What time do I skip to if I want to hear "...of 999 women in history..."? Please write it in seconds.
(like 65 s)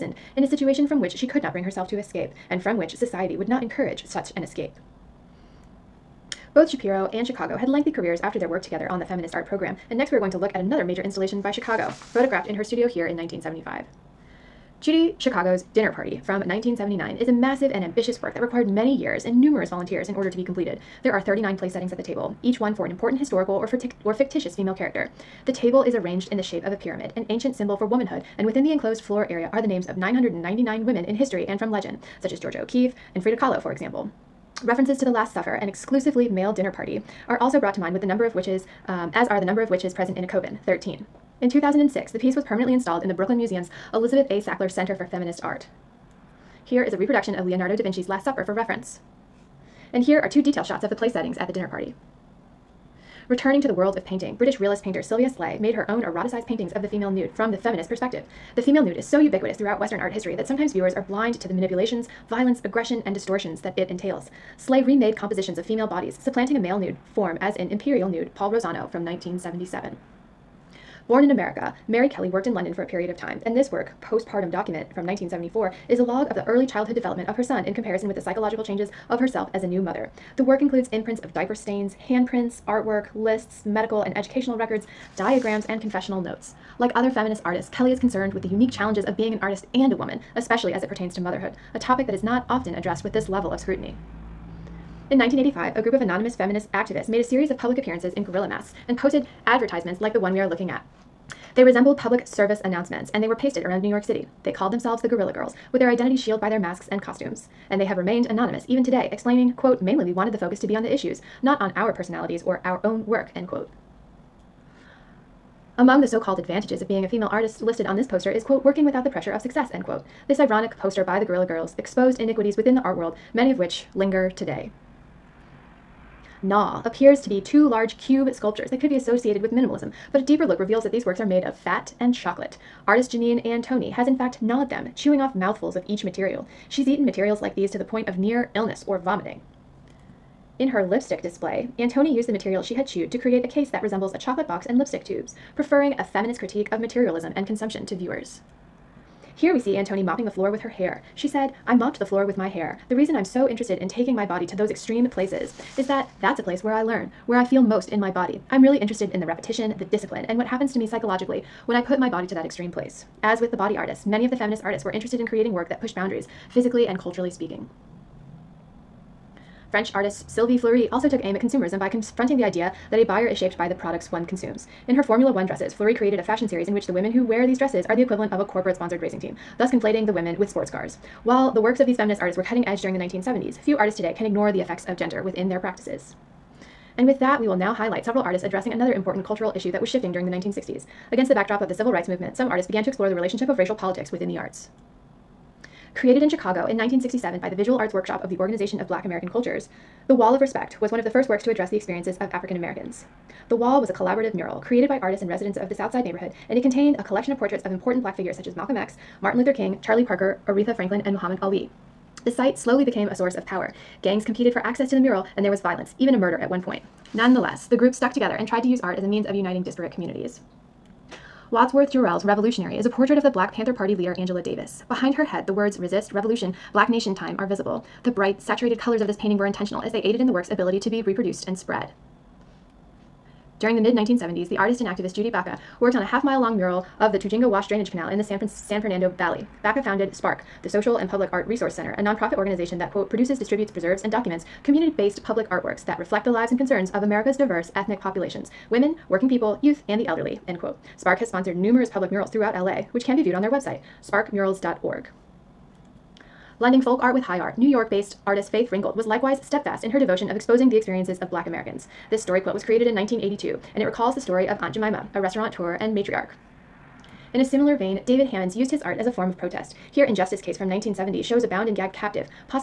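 29 s.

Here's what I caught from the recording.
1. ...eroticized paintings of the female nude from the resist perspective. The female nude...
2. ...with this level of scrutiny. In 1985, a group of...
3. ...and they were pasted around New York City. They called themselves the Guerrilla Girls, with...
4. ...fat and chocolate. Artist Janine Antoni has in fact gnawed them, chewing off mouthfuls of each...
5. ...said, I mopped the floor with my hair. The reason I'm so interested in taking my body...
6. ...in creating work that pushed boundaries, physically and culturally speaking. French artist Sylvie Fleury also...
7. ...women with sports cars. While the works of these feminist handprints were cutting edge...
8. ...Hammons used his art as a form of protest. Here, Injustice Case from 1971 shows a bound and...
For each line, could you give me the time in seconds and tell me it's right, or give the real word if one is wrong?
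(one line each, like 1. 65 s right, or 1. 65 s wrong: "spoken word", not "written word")
1. 56 s wrong: "feminist", not "resist"
2. 93 s right
3. 103 s right
4. 131 s right
5. 151 s right
6. 165 s right
7. 180 s wrong: "artists", not "handprints"
8. 268 s wrong: "1970", not "1971".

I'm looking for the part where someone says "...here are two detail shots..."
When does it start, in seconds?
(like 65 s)
50 s.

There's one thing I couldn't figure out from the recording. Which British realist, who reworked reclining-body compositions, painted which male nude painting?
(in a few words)
Imperial Nude, Paul Rosano.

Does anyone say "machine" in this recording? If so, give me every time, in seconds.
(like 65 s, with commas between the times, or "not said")
not said.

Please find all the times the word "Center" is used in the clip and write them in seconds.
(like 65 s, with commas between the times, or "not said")
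44 s, 241 s.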